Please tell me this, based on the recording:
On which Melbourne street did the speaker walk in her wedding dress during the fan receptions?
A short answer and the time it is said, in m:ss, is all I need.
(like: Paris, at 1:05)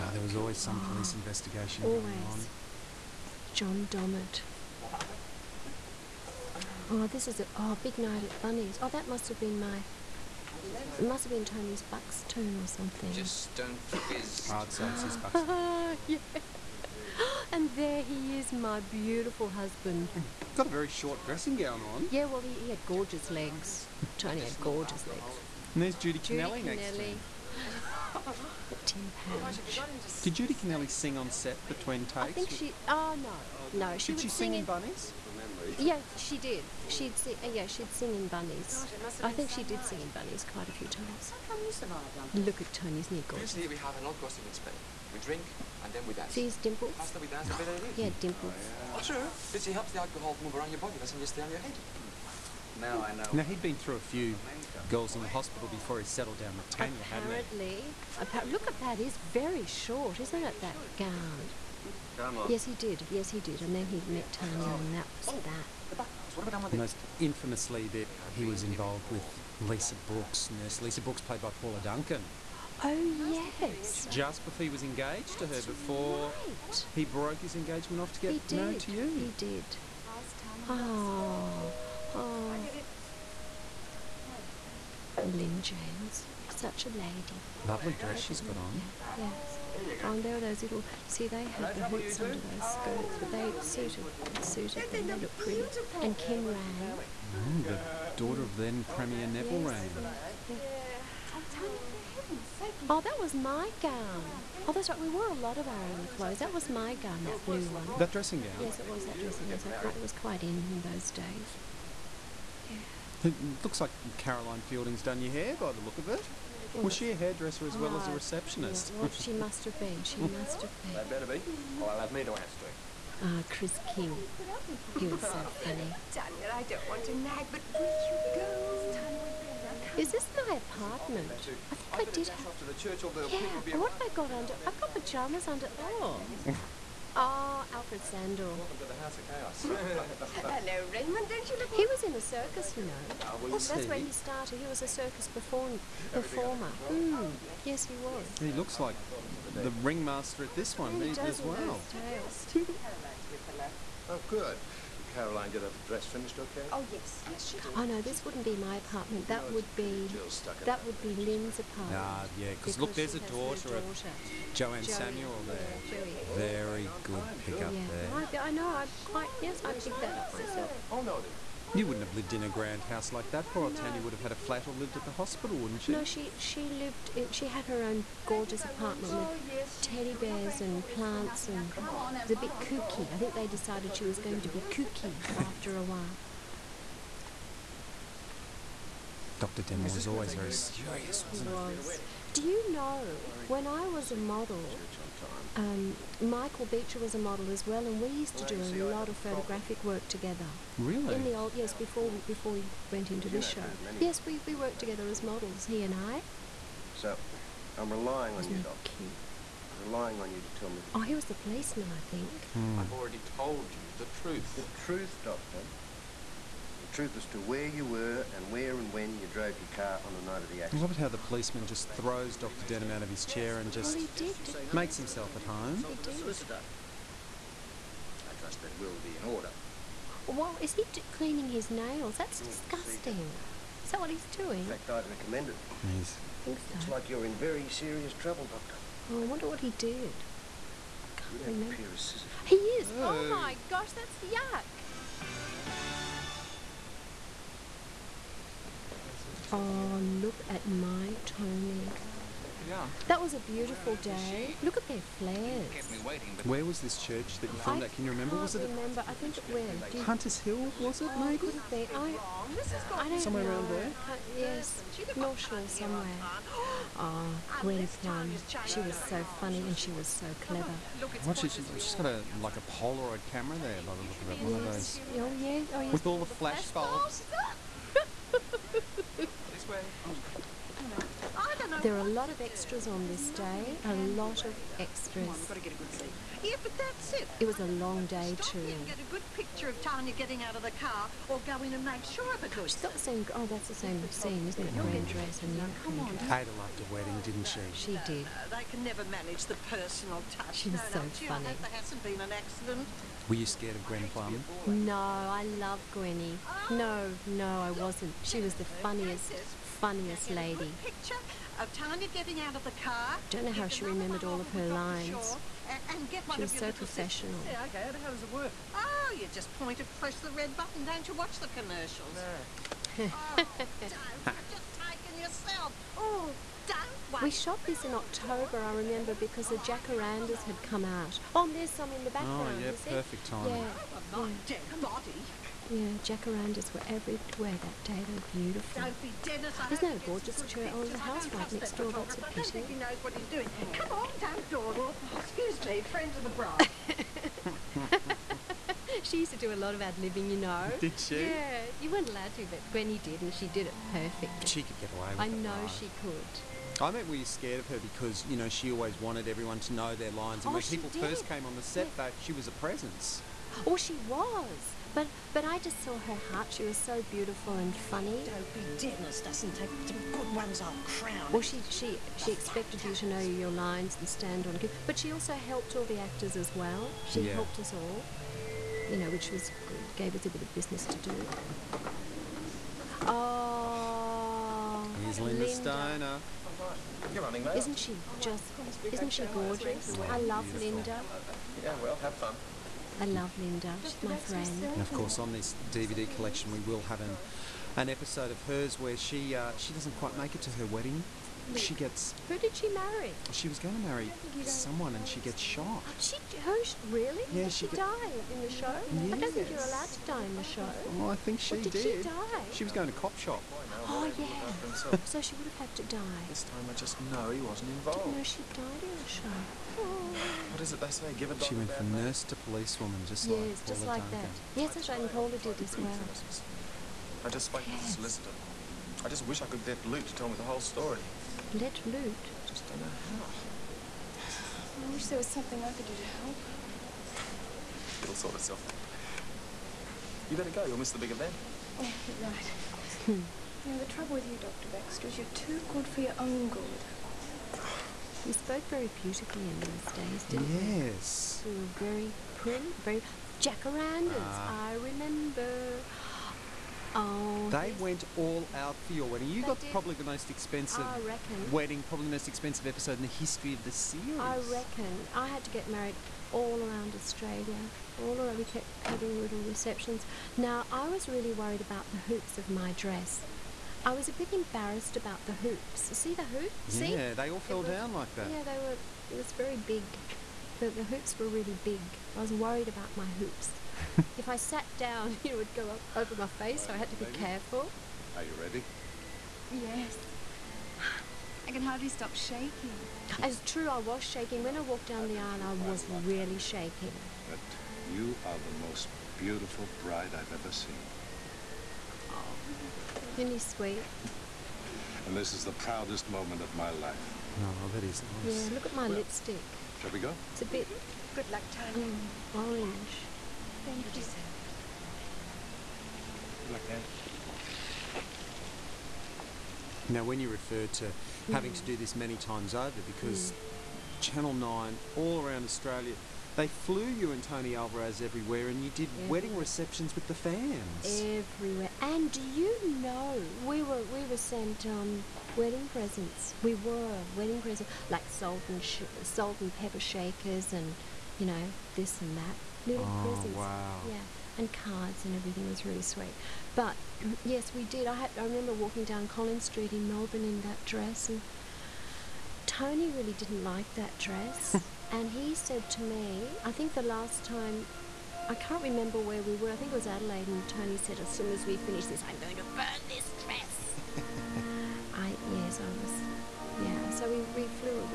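Collins Street, at 9:09.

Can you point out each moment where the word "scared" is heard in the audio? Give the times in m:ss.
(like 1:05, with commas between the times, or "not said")
5:03, 5:57.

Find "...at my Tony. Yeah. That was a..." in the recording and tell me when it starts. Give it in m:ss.
4:10.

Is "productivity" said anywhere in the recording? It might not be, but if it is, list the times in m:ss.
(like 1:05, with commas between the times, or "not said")
not said.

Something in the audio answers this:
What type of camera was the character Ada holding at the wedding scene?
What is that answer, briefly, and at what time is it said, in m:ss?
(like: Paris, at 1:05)
Polaroid camera, at 4:32.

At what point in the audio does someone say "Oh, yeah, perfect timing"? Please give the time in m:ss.
5:32.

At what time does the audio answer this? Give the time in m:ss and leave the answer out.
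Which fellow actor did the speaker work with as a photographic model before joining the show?
3:16.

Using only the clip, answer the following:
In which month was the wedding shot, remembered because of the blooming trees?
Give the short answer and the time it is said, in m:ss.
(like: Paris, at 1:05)
October, at 5:27.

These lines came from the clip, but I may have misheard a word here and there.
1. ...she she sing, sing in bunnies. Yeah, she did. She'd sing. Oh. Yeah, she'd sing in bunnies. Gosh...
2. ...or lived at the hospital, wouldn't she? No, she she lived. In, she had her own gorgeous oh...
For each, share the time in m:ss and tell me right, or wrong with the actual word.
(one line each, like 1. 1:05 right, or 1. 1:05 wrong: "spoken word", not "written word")
1. 0:34 right
2. 2:54 right.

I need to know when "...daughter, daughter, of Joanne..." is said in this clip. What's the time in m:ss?
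2:43.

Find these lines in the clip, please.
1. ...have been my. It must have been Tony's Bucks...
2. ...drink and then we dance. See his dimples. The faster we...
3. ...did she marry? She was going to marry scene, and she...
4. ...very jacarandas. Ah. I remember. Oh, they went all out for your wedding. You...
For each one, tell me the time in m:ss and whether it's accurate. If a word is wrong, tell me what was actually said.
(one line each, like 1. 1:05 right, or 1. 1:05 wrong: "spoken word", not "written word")
1. 0:09 right
2. 0:45 right
3. 6:42 wrong: "someone", not "scene"
4. 7:32 right.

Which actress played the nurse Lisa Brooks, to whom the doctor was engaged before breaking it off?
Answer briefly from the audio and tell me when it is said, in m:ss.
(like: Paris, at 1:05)
Paula Duncan, at 1:11.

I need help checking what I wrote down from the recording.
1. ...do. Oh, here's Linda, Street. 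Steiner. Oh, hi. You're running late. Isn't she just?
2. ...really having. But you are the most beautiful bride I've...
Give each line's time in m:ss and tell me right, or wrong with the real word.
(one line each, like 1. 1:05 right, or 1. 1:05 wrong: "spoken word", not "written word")
1. 6:20 wrong: "Linda", not "Street"
2. 8:15 wrong: "shaking", not "having".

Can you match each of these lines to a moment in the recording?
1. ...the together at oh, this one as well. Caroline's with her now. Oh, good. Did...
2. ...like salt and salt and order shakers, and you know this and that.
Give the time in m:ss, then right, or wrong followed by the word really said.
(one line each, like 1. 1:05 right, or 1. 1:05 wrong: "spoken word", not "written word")
1. 2:29 wrong: "ringmaster", not "together"
2. 8:57 wrong: "pepper", not "order".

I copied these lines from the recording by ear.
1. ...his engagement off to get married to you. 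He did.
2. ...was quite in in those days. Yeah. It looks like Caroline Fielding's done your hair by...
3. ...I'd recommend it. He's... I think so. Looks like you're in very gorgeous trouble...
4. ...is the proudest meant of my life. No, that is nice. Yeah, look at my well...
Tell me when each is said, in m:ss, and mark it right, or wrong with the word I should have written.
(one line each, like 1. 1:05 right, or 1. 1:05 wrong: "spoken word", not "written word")
1. 1:17 right
2. 1:50 right
3. 3:54 wrong: "serious", not "gorgeous"
4. 8:25 wrong: "moment", not "meant".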